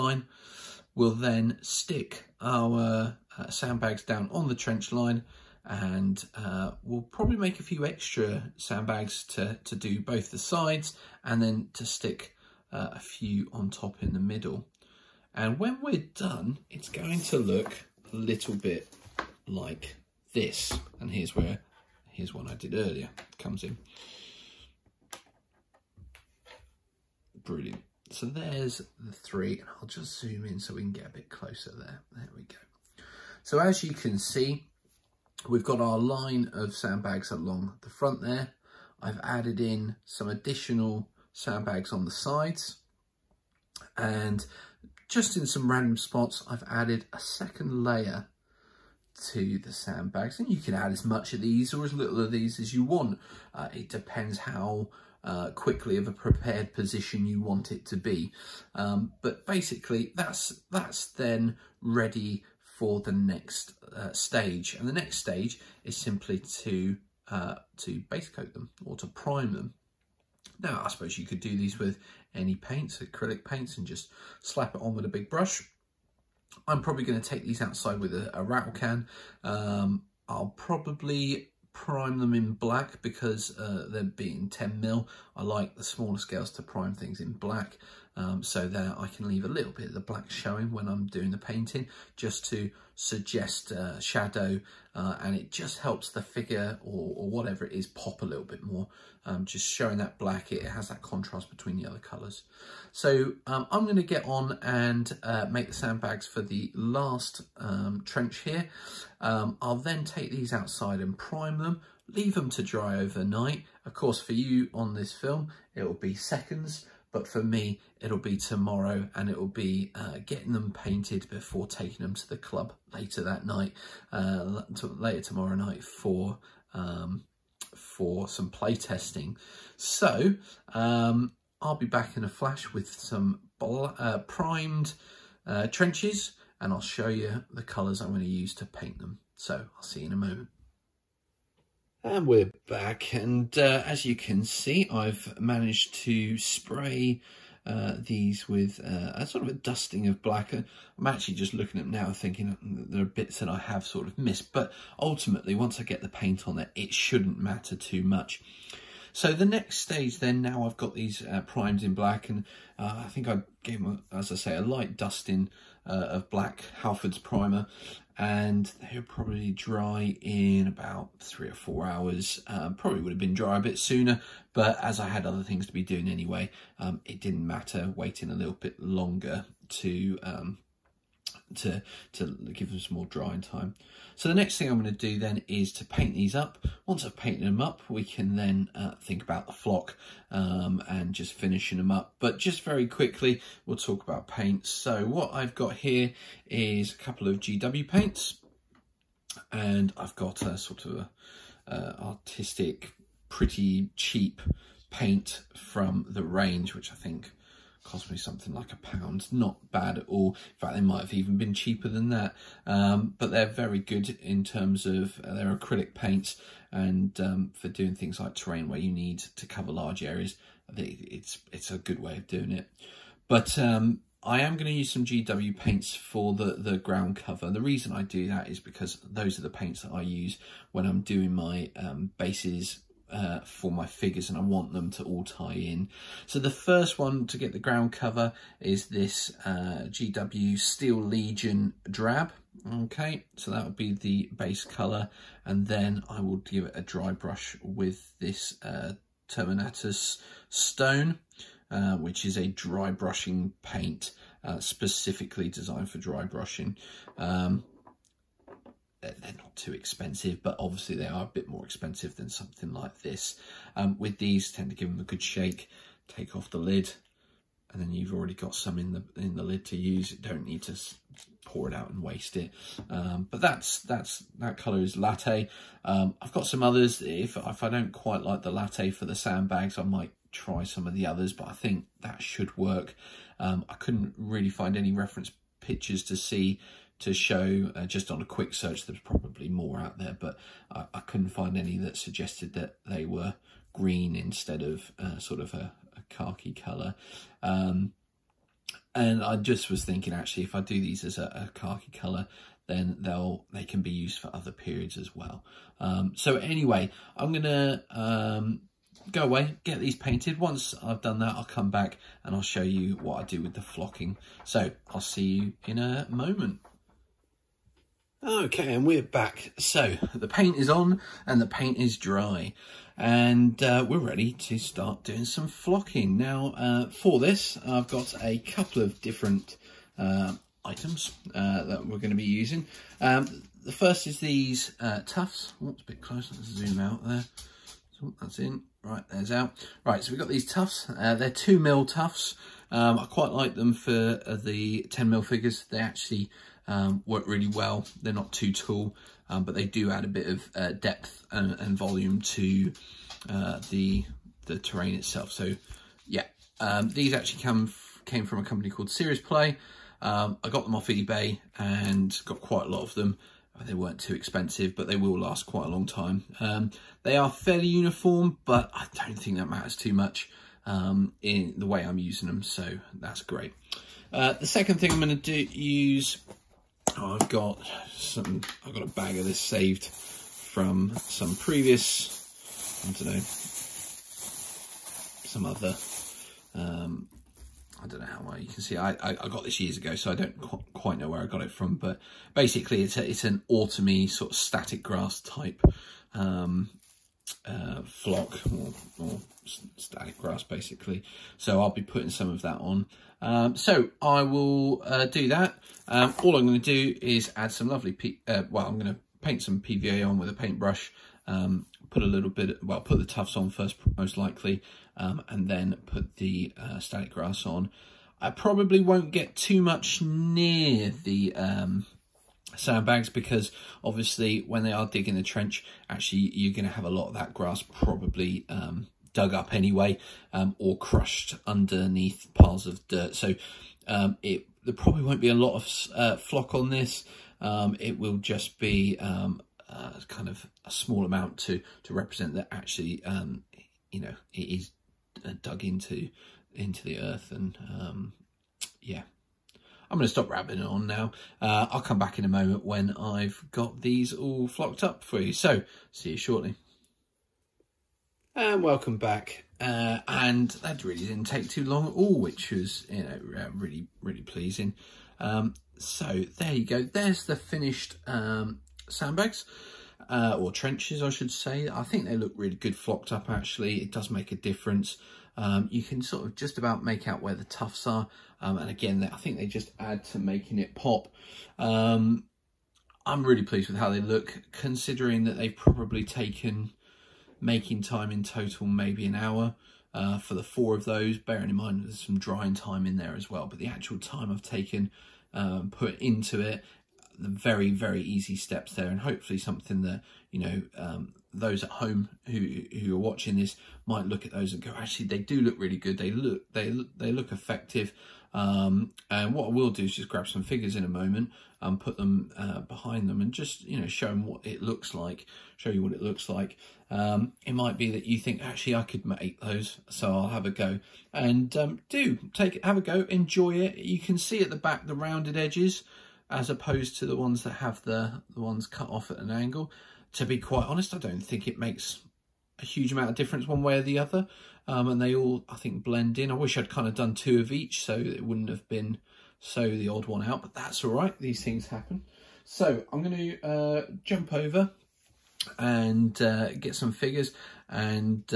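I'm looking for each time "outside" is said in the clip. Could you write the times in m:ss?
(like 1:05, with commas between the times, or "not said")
1:17, 1:50.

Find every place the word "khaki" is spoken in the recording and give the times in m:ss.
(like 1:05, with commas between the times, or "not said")
4:56, 5:01.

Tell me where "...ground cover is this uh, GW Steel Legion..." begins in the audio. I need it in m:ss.
3:57.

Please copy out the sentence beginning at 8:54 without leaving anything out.
Um, and they all, I think, blend in.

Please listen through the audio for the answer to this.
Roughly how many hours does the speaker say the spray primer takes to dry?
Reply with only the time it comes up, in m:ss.
2:51.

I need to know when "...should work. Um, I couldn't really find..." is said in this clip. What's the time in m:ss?
4:42.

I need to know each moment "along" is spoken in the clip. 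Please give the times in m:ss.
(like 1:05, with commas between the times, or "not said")
0:37.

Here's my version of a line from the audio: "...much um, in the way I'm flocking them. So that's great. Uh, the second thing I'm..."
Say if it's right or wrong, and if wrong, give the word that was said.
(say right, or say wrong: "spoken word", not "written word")
wrong: "using", not "flocking".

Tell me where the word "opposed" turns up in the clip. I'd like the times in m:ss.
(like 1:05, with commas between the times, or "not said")
8:46.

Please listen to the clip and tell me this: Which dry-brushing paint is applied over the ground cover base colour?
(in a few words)
Terminatus Stone.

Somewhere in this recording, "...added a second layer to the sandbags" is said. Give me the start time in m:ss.
0:46.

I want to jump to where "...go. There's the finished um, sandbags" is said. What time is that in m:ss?
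7:46.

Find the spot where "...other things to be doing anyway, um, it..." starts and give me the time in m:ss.
2:55.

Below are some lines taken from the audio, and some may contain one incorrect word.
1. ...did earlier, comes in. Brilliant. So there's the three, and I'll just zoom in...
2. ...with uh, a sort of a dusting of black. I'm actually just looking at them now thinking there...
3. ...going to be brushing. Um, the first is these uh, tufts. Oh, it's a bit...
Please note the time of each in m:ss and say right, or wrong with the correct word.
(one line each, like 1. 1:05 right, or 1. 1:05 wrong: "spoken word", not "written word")
1. 0:22 right
2. 2:28 right
3. 5:31 wrong: "using", not "brushing".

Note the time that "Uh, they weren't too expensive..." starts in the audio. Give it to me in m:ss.
6:03.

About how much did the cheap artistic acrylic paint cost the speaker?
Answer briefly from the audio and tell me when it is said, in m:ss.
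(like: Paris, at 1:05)
A pound, at 3:28.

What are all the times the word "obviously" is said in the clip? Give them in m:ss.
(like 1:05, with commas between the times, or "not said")
4:20, 7:03.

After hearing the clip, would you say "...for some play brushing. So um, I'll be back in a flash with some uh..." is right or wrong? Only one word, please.
wrong.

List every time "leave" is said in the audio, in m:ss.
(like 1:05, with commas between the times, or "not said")
1:29, 1:52.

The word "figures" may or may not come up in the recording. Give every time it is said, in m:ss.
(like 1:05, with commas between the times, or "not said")
1:36, 3:53, 5:45, 8:30, 9:06.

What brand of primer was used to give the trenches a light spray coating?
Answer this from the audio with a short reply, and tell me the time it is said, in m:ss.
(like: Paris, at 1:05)
Halfords, at 2:46.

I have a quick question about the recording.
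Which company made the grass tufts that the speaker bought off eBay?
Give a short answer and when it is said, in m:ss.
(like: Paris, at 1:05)
Serious Play, at 5:58.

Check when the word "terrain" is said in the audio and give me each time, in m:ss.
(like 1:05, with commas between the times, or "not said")
3:38, 5:54.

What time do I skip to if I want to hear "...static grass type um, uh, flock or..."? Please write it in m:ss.
6:34.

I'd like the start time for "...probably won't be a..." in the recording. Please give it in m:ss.
7:14.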